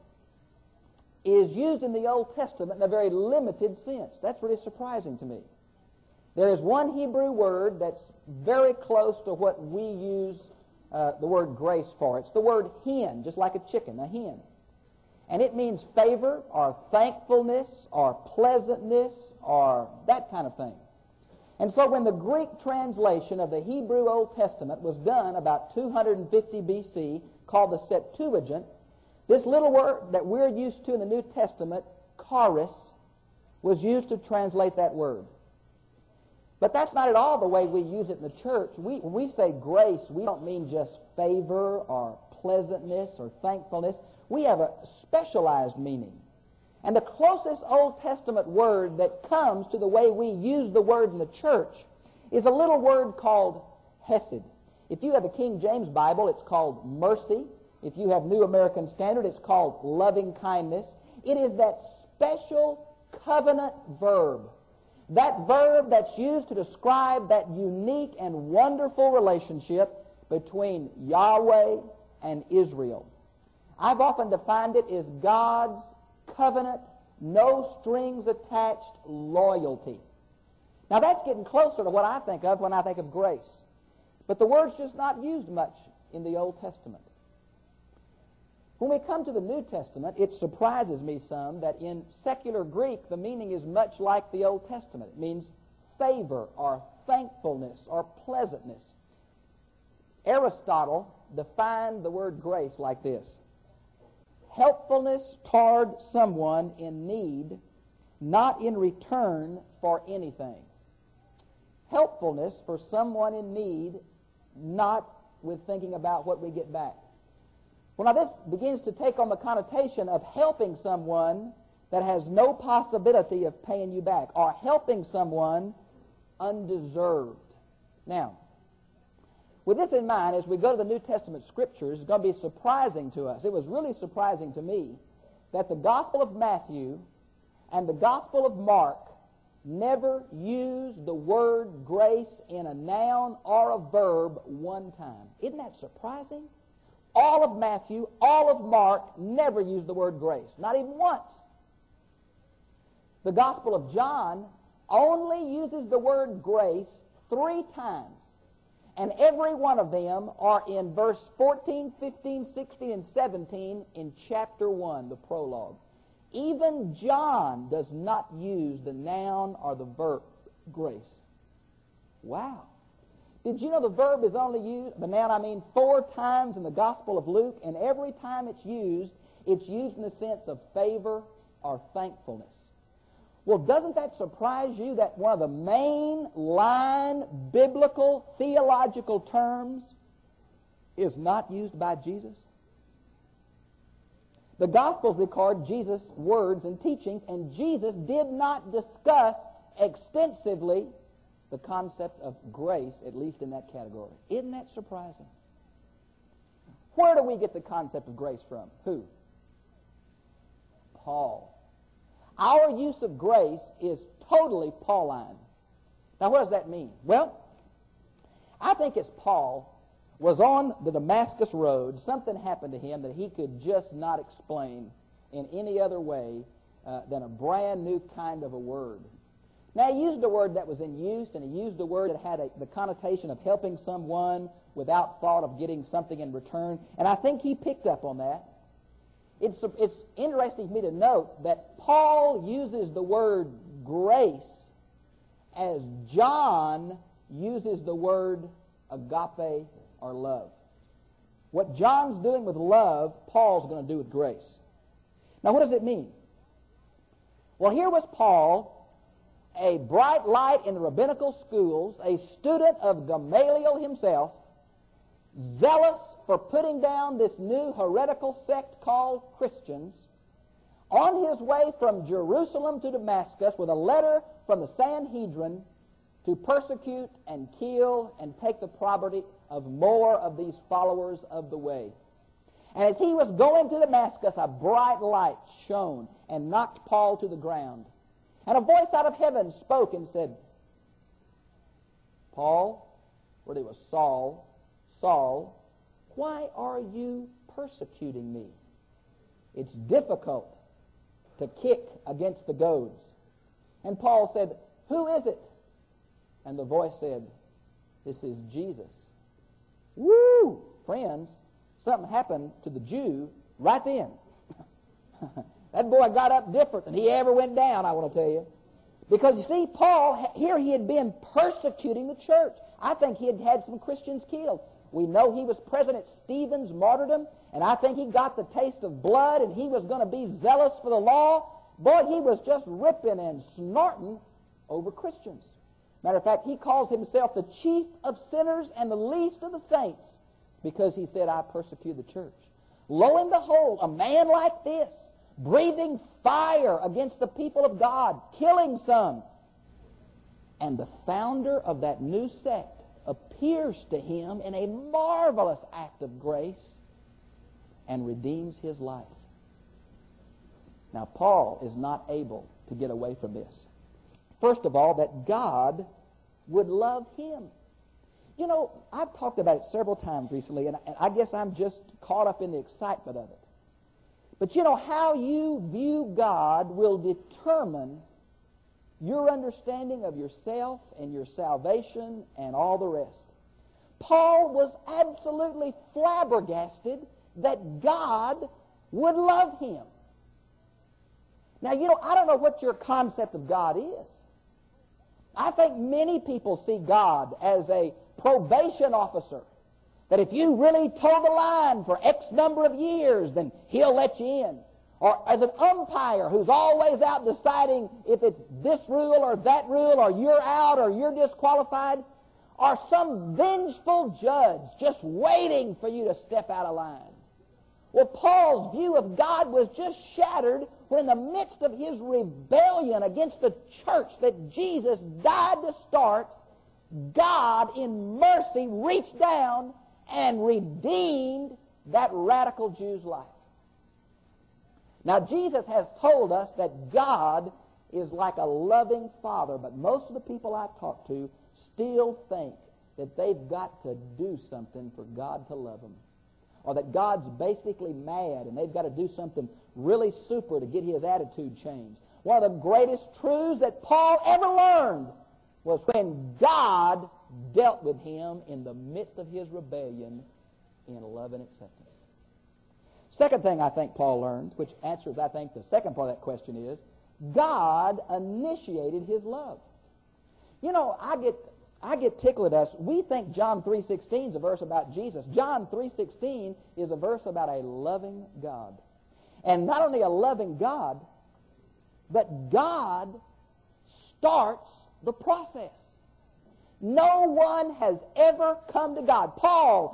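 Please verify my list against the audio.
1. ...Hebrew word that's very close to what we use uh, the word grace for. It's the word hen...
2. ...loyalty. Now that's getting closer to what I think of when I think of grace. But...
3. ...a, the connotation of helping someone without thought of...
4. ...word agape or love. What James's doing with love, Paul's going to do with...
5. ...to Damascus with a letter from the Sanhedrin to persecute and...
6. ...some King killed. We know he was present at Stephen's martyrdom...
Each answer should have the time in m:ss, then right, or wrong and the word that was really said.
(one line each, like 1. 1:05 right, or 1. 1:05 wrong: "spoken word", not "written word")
1. 0:06 right
2. 1:19 right
3. 3:52 right
4. 4:07 wrong: "John", not "James"
5. 4:32 right
6. 5:23 wrong: "Christians", not "King".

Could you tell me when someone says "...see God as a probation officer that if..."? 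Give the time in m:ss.
6:36.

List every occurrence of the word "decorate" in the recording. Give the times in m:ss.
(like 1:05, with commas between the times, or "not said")
not said.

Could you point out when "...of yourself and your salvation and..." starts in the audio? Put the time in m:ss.
6:20.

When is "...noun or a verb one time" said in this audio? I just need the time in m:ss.
2:22.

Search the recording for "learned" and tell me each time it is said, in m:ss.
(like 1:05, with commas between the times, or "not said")
7:34, 7:44.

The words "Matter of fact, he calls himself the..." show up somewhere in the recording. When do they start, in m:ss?
5:36.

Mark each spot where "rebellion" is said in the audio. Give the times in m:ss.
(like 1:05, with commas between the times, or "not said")
7:02, 7:39.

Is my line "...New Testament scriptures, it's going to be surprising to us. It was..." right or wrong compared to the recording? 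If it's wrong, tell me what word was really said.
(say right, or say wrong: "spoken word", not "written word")
right.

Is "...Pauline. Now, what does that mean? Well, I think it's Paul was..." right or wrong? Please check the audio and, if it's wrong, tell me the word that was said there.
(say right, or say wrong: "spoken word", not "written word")
right.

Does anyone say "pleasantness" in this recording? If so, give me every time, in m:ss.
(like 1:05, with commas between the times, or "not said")
0:18, 0:42, 1:38.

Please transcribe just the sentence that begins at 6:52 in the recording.
Or some vengeful judge just waiting for you to step out of line.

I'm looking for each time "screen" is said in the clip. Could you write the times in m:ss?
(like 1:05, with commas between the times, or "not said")
not said.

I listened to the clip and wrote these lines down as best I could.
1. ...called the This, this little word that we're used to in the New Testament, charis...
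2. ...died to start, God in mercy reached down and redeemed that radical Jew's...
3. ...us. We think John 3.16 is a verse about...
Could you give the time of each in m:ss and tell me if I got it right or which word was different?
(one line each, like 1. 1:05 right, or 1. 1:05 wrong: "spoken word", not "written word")
1. 0:27 wrong: "Septuagint", not "This"
2. 7:05 right
3. 7:52 right.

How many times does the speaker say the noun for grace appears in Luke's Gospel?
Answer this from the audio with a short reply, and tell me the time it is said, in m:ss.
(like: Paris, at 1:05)
4, at 2:55.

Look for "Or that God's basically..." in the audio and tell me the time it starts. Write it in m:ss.
7:26.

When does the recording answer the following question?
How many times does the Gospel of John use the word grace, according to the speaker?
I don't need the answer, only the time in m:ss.
2:37.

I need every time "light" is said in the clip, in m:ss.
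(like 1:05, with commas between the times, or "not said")
4:20, 4:45.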